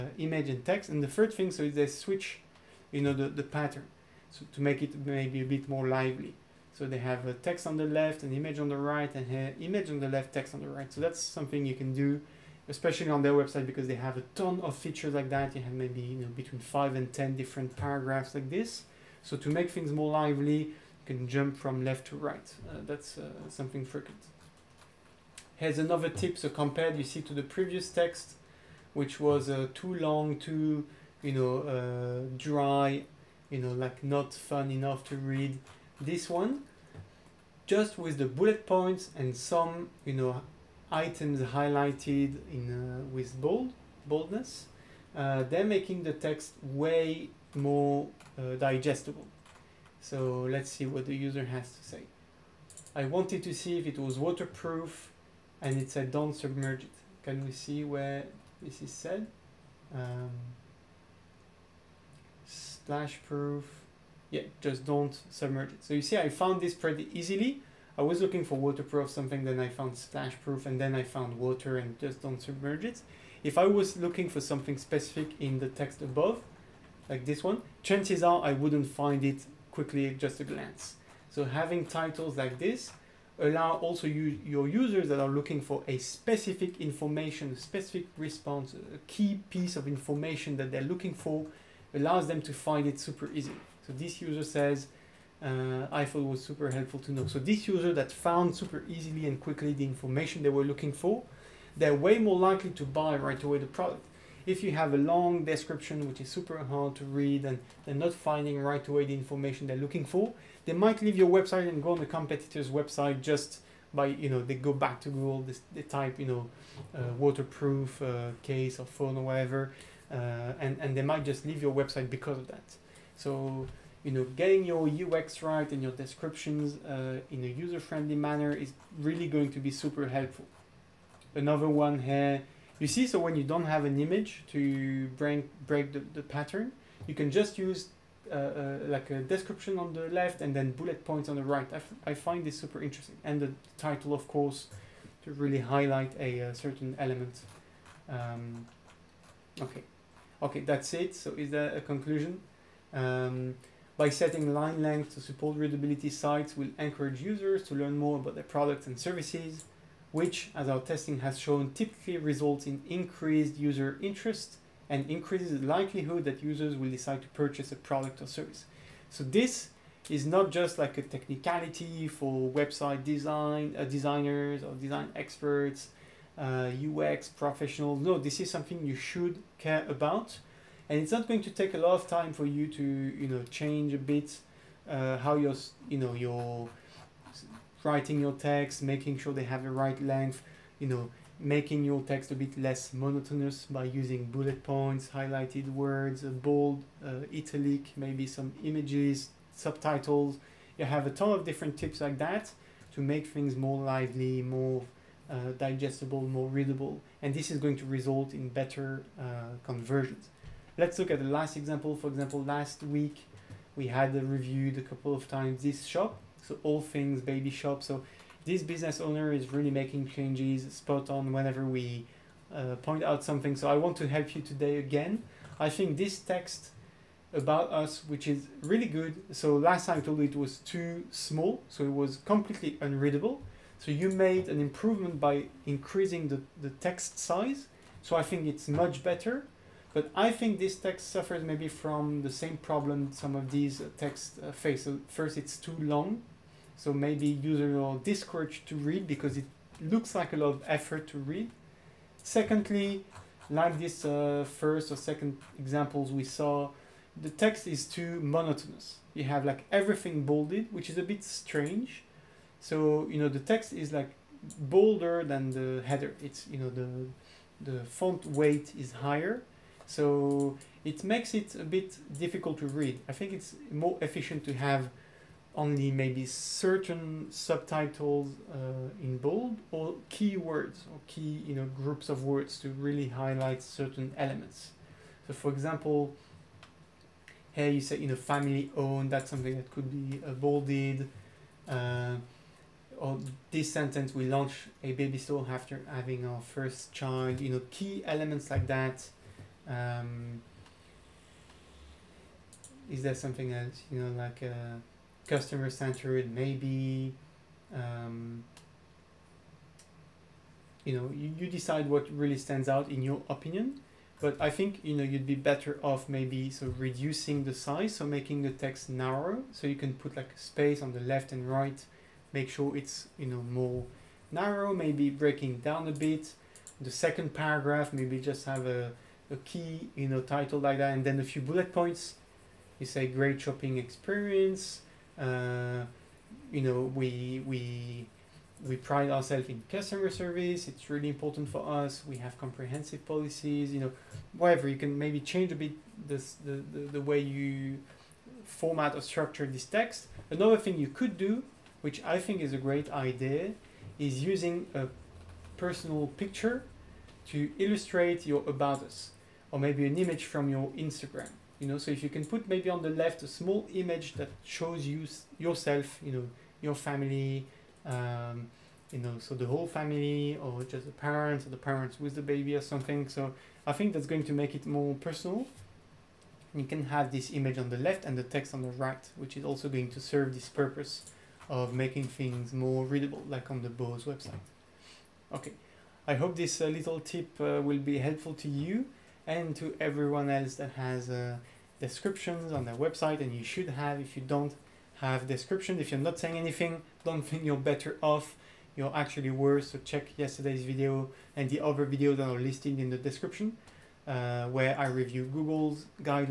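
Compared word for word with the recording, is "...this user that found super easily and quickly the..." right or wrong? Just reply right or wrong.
right.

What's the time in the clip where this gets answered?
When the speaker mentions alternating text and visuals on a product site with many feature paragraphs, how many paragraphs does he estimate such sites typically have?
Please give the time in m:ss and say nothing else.
0:16.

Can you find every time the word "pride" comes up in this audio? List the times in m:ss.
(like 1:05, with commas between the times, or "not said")
5:38.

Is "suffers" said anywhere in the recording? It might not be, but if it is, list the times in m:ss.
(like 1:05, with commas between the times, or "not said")
4:01.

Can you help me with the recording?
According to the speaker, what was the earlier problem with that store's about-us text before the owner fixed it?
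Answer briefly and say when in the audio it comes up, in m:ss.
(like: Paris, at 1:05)
Too small, at 3:50.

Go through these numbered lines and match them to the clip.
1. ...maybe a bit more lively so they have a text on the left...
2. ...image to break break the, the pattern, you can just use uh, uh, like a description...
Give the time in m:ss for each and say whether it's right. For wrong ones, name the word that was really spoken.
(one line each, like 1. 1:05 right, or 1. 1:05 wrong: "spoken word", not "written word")
1. 0:05 right
2. 2:13 right.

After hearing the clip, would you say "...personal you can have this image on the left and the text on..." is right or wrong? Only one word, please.
right.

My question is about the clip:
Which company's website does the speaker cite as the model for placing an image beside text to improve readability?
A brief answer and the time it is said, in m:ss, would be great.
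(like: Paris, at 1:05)
Bose, at 6:23.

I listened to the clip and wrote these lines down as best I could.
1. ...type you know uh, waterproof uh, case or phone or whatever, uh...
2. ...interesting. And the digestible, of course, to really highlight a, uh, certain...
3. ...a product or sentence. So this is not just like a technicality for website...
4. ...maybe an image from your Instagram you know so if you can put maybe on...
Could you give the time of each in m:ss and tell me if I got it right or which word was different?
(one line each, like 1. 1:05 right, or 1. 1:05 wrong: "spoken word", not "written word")
1. 1:55 right
2. 2:22 wrong: "title", not "digestible"
3. 2:47 wrong: "service", not "sentence"
4. 5:59 right.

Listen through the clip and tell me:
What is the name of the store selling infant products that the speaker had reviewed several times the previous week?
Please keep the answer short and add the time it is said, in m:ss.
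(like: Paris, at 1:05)
All Things Baby, at 3:36.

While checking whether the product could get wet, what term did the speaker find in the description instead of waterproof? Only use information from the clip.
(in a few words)
Splash proof.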